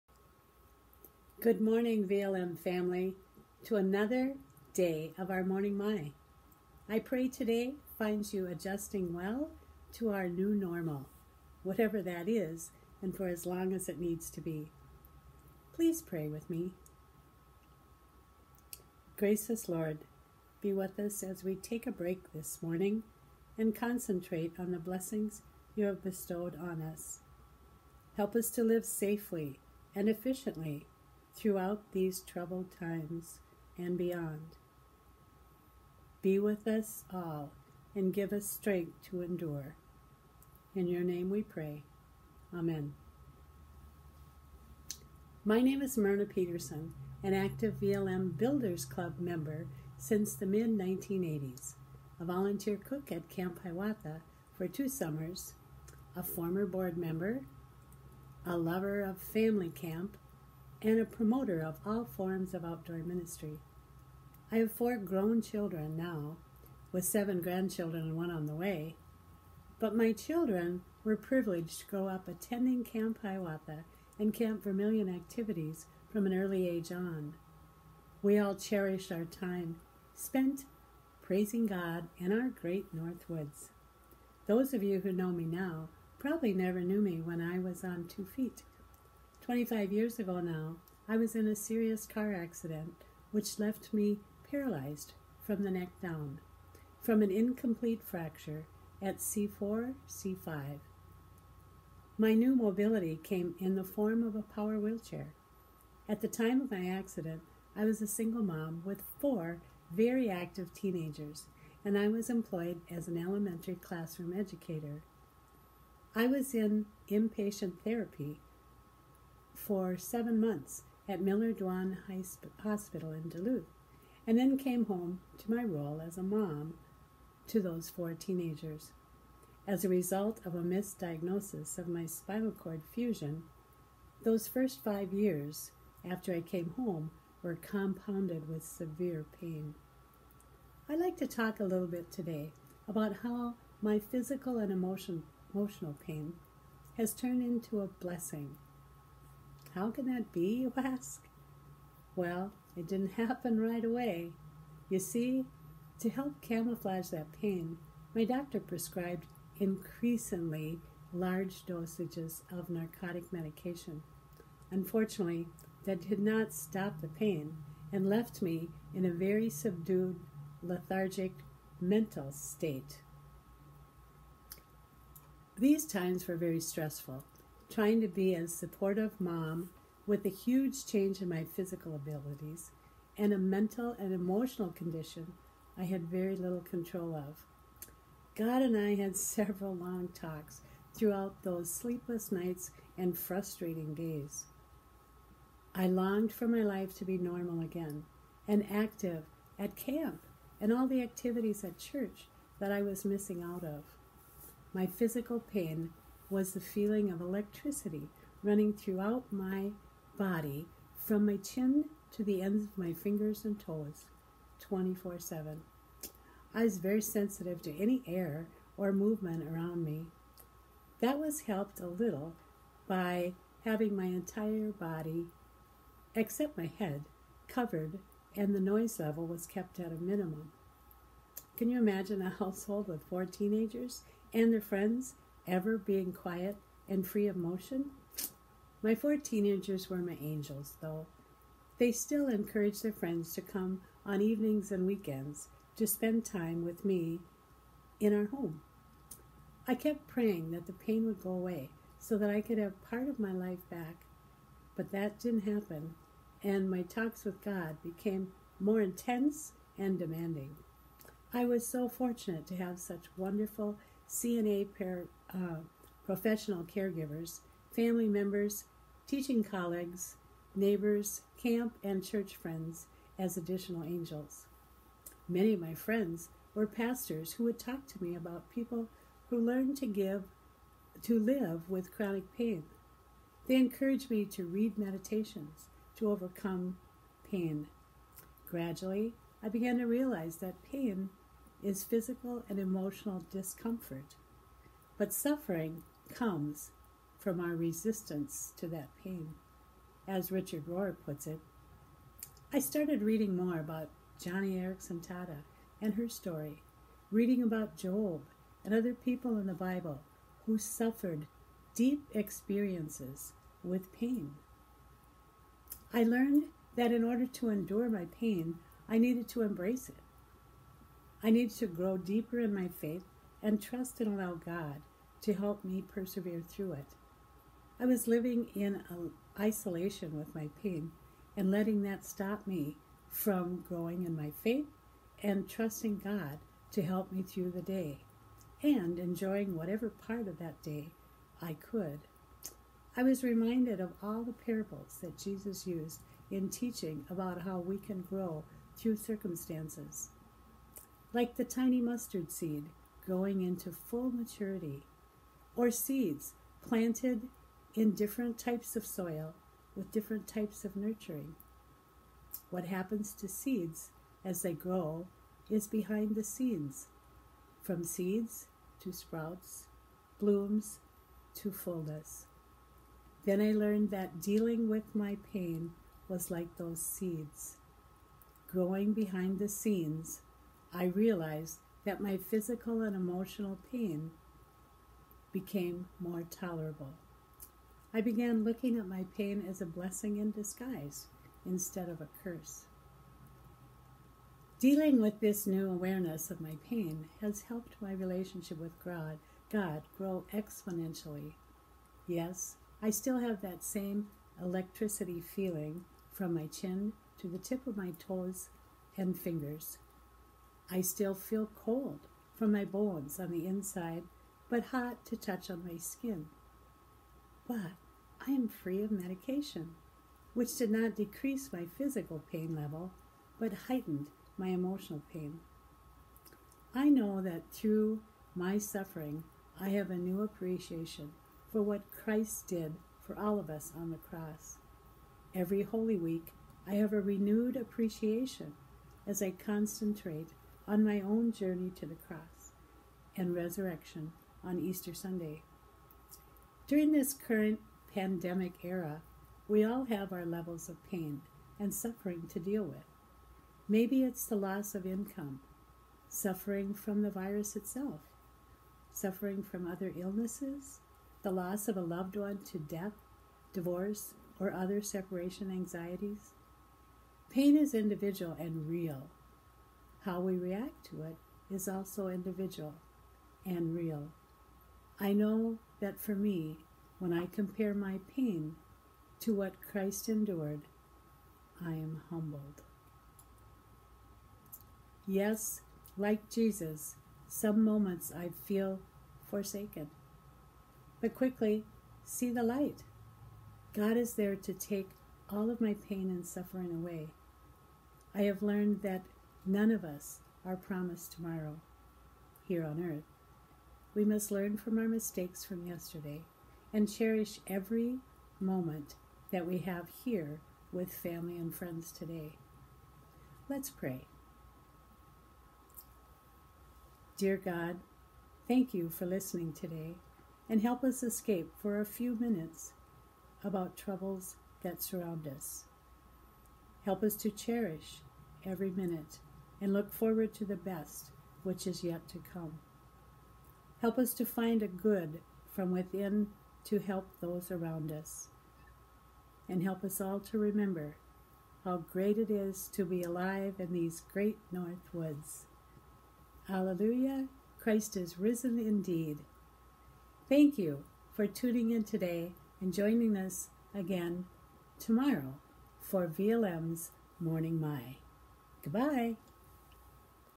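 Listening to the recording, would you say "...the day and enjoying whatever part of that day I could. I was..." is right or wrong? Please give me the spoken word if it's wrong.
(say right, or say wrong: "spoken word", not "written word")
right.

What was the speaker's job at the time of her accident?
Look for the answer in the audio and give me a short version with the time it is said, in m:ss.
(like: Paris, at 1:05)
Elementary classroom educator, at 1:53.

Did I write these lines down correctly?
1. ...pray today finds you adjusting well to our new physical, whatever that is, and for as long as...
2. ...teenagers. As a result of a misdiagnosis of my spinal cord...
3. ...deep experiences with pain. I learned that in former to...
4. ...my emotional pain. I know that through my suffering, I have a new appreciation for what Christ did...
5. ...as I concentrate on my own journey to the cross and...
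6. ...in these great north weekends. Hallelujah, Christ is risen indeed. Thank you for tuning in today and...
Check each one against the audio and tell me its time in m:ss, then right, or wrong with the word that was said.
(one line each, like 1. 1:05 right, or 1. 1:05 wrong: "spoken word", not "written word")
1. 0:06 wrong: "normal", not "physical"
2. 2:08 right
3. 5:11 wrong: "order", not "former"
4. 7:04 right
5. 7:19 right
6. 9:03 wrong: "woods", not "weekends".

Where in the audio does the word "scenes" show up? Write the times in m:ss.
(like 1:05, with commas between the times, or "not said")
6:06, 6:19.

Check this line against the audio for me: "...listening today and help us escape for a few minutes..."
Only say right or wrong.
right.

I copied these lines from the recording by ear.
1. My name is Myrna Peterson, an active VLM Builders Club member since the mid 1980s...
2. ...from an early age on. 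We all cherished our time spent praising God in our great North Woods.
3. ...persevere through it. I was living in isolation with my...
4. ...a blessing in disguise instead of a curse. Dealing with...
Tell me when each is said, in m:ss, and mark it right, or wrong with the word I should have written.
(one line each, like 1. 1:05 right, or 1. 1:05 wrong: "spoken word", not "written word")
1. 0:45 right
2. 1:16 right
3. 5:25 right
4. 6:29 right.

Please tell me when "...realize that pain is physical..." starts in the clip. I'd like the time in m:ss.
4:49.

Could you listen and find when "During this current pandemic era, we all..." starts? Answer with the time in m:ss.
7:26.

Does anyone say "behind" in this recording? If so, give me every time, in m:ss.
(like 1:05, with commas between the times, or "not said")
6:05, 6:18.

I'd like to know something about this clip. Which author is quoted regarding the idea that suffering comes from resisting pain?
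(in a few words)
Richard Rohr.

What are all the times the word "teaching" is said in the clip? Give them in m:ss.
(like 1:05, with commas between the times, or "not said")
4:29, 5:46.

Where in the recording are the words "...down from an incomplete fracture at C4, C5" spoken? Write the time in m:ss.
1:35.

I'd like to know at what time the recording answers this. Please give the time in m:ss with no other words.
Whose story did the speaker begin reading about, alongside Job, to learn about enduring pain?
5:04.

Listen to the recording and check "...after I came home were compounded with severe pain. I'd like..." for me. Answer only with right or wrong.
right.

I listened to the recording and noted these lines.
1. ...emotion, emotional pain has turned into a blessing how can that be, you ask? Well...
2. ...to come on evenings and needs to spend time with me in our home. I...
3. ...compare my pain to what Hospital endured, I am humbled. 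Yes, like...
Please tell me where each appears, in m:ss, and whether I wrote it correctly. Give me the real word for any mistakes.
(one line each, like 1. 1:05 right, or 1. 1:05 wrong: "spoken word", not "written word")
1. 2:24 right
2. 4:03 wrong: "weekends", not "needs"
3. 7:57 wrong: "Christ", not "Hospital".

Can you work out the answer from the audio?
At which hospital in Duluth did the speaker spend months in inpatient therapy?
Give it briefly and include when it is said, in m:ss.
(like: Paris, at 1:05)
Miller Dwan Hospital, at 2:01.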